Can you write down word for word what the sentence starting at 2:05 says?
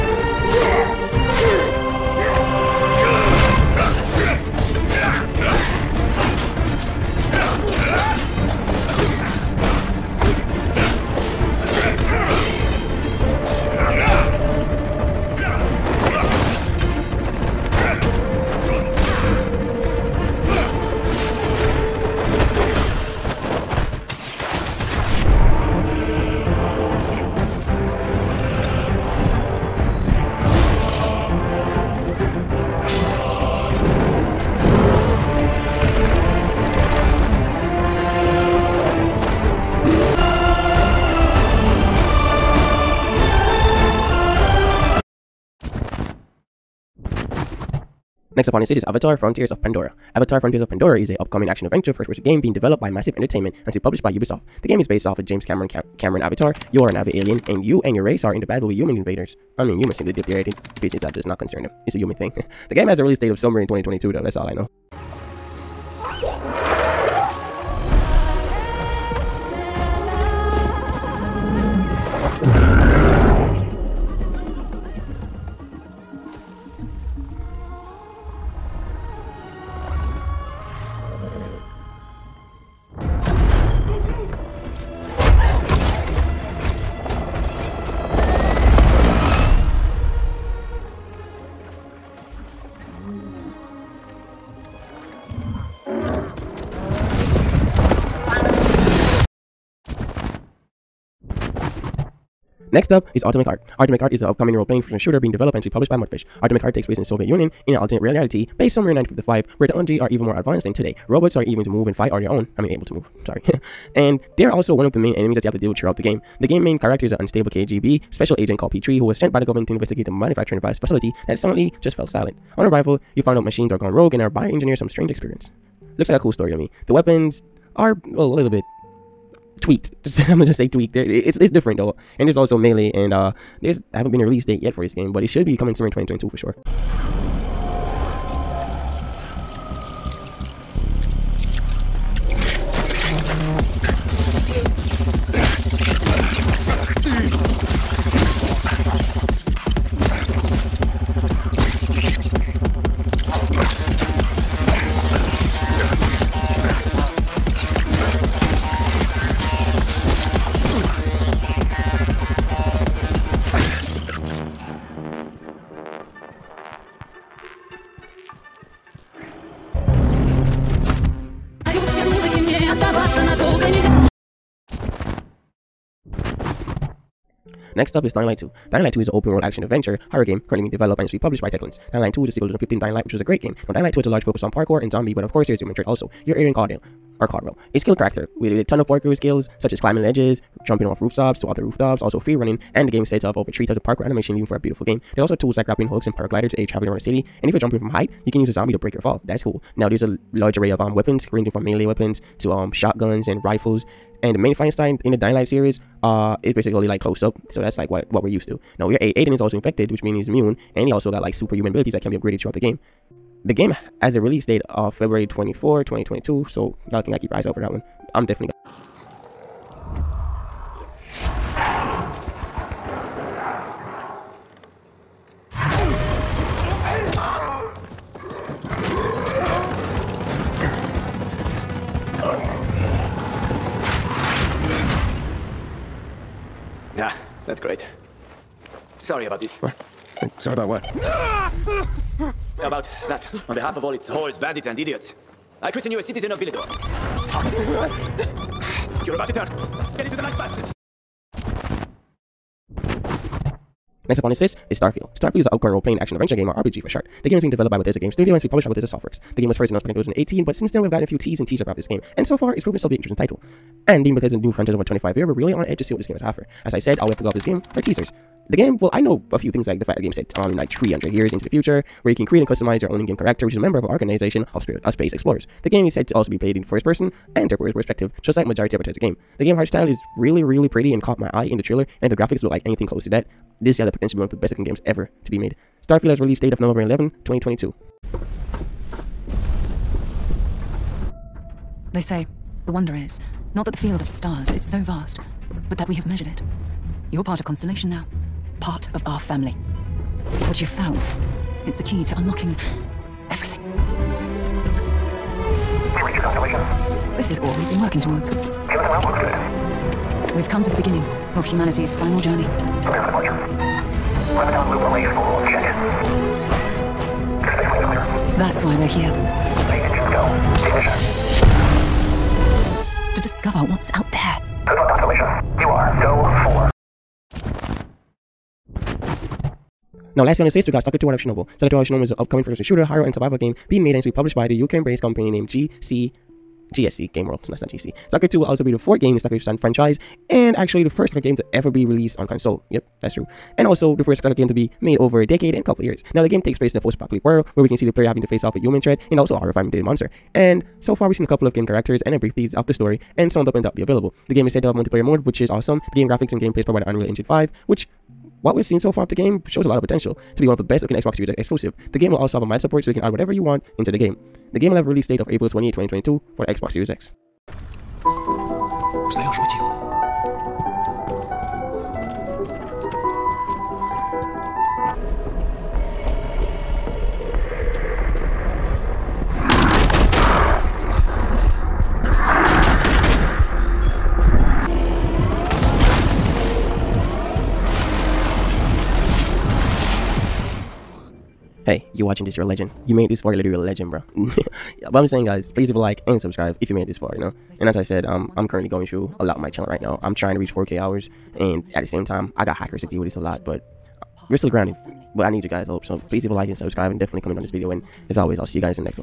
Looks like a cool story to me.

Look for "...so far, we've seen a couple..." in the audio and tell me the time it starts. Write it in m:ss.
5:50.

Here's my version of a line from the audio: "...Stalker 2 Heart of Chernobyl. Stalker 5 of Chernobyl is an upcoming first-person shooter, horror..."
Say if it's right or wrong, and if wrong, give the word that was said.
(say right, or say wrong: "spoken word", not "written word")
wrong: "2", not "5".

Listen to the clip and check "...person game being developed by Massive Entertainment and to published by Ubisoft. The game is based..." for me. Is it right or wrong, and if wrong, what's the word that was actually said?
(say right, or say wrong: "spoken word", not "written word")
right.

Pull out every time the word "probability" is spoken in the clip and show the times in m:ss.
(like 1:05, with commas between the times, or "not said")
not said.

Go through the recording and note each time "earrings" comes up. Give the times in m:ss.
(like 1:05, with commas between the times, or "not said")
not said.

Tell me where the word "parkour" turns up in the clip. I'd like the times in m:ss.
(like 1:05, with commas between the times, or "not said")
3:04, 3:08, 3:13.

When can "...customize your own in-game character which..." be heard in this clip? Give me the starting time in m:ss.
4:32.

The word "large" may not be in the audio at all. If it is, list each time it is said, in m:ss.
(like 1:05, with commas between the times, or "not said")
3:04, 3:20.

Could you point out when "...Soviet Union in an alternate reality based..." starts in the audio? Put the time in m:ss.
1:47.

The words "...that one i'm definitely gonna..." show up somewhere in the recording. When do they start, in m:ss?
3:37.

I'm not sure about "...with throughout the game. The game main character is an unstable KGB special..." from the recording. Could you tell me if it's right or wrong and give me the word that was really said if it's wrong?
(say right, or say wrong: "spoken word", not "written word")
right.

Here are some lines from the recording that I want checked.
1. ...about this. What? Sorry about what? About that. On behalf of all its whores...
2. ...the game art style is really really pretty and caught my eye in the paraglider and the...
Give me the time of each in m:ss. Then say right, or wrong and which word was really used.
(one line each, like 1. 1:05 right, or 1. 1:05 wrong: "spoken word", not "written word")
1. 3:59 right
2. 4:39 wrong: "trailer", not "paraglider".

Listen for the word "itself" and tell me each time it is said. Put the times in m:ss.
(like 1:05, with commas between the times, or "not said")
4:22.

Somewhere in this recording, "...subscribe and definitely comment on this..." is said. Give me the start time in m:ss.
6:46.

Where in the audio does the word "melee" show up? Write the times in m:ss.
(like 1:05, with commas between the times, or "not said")
2:12, 3:21.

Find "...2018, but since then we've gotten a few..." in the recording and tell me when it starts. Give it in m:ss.
4:19.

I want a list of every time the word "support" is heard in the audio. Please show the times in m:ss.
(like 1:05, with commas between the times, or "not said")
6:02.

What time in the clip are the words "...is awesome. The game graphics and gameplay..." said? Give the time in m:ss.
5:55.